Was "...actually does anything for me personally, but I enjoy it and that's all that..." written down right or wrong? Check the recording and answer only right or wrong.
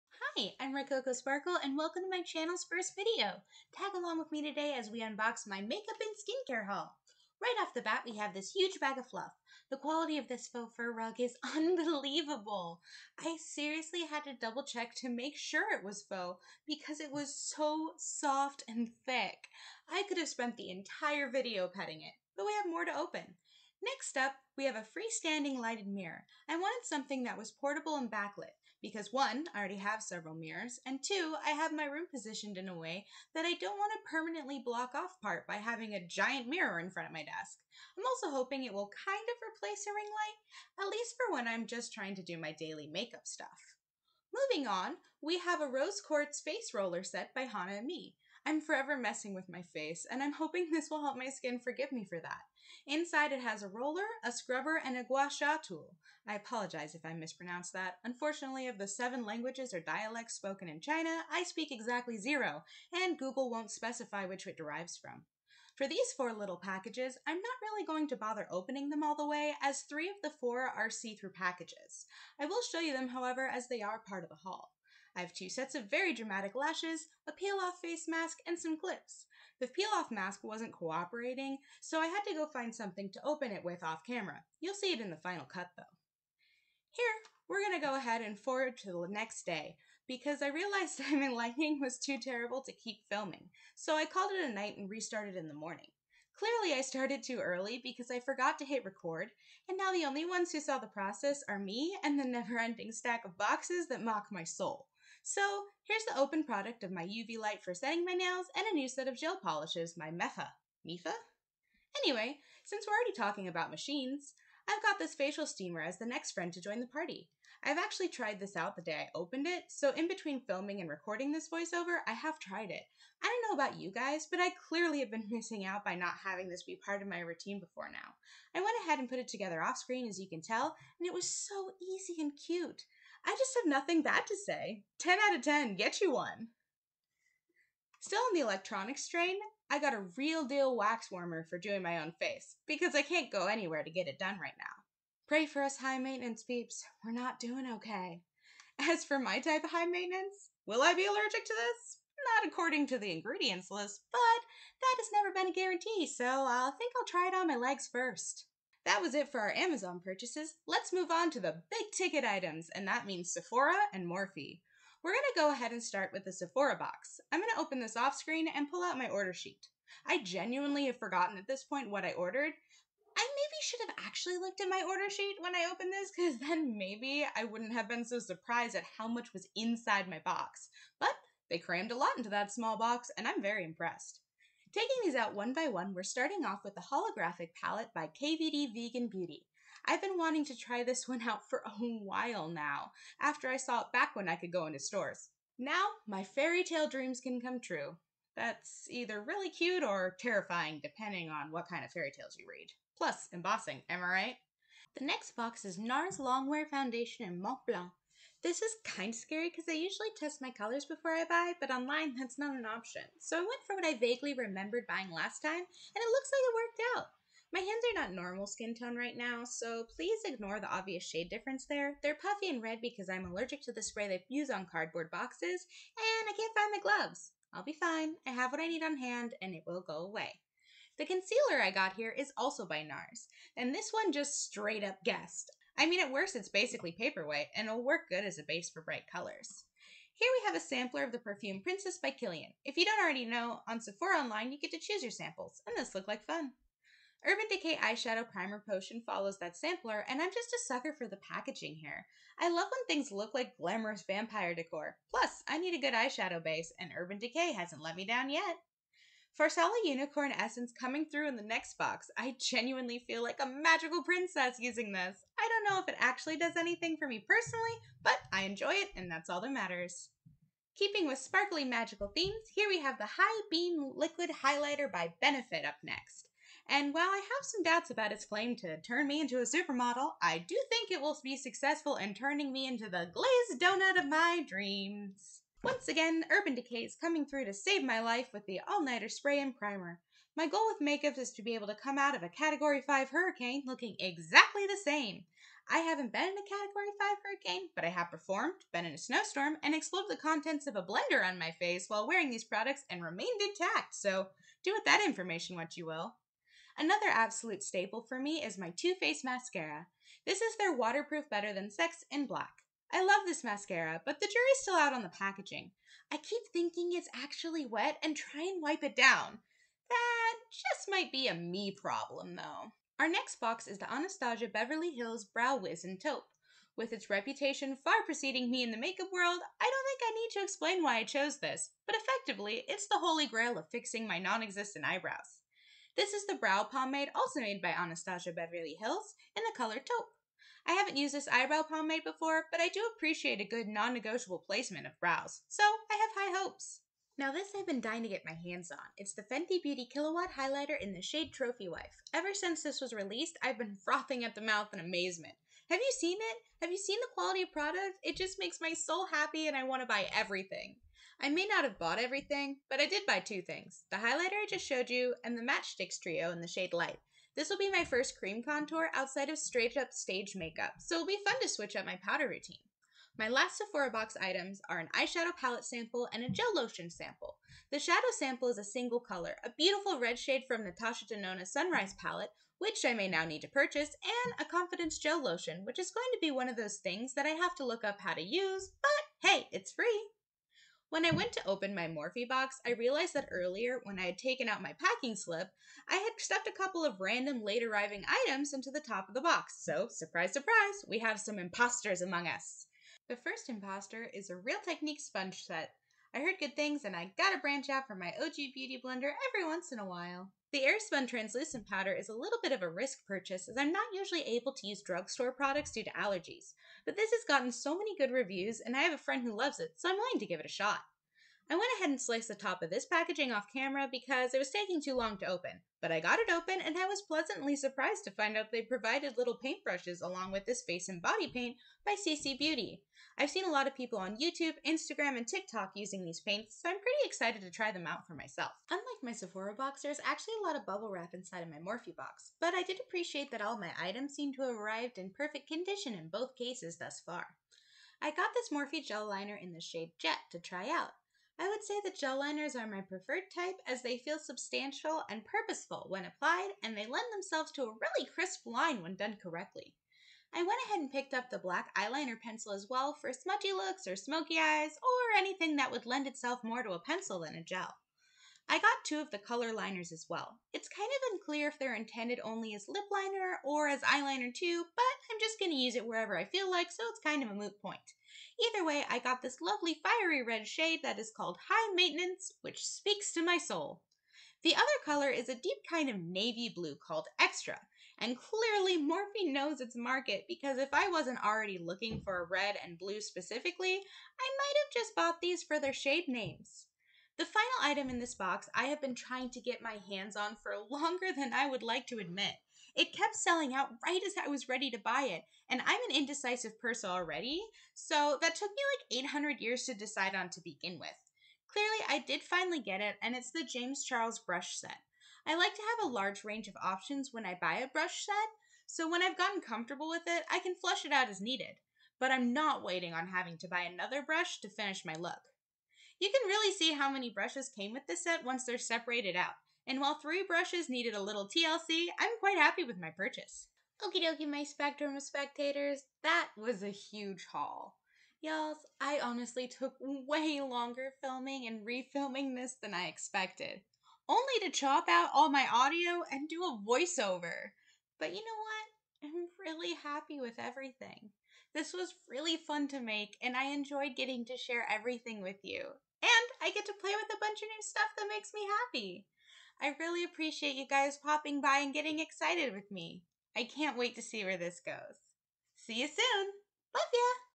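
right.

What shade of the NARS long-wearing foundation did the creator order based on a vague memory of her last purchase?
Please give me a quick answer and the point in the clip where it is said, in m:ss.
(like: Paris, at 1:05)
Mont Blanc, at 3:27.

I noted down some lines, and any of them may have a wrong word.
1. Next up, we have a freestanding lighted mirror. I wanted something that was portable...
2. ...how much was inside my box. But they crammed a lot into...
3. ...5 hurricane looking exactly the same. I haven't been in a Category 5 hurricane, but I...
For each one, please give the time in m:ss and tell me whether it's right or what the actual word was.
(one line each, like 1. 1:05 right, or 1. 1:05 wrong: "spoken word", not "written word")
1. 0:23 right
2. 2:58 right
3. 4:52 right.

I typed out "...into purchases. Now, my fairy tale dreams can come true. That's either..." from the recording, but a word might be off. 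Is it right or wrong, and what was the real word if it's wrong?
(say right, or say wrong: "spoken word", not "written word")
wrong: "stores", not "purchases".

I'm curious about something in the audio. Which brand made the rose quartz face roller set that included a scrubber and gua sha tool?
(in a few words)
Hana and me.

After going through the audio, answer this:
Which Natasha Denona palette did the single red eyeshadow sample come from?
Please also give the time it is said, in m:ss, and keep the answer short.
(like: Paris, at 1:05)
Sunrise, at 6:21.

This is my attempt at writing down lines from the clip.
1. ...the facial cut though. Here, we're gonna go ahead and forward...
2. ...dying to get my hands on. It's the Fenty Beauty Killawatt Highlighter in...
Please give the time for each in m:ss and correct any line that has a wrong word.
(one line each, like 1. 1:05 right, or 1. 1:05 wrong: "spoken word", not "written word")
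1. 1:25 wrong: "final", not "facial"
2. 5:47 right.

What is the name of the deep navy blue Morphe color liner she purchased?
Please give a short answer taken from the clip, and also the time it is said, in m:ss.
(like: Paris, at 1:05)
Extra, at 8:07.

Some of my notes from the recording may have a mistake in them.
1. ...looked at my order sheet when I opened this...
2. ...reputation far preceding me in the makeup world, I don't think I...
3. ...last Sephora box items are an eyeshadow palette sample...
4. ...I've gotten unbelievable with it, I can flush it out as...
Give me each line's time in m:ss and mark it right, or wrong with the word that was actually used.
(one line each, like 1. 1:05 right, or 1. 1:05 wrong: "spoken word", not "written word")
1. 2:54 right
2. 5:27 right
3. 6:13 right
4. 8:39 wrong: "comfortable", not "unbelievable".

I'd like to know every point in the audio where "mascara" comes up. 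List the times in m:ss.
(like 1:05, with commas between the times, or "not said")
5:09, 5:13.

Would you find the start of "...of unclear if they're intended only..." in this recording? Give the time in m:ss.
7:50.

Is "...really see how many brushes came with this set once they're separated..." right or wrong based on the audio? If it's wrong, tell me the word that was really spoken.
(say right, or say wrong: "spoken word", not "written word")
right.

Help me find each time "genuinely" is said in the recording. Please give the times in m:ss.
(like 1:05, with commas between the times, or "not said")
2:50, 4:22.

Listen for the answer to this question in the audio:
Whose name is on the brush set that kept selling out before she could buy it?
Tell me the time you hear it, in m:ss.
8:33.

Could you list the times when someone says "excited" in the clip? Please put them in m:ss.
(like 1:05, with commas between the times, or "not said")
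7:17, 9:21.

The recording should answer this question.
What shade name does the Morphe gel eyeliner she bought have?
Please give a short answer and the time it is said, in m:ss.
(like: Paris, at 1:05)
Jet, at 7:29.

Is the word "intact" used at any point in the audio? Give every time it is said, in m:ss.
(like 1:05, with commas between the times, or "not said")
5:03.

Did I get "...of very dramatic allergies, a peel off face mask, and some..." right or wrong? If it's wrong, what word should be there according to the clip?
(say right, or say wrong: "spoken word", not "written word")
wrong: "lashes", not "allergies".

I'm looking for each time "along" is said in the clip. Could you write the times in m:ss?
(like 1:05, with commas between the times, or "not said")
0:03, 7:10.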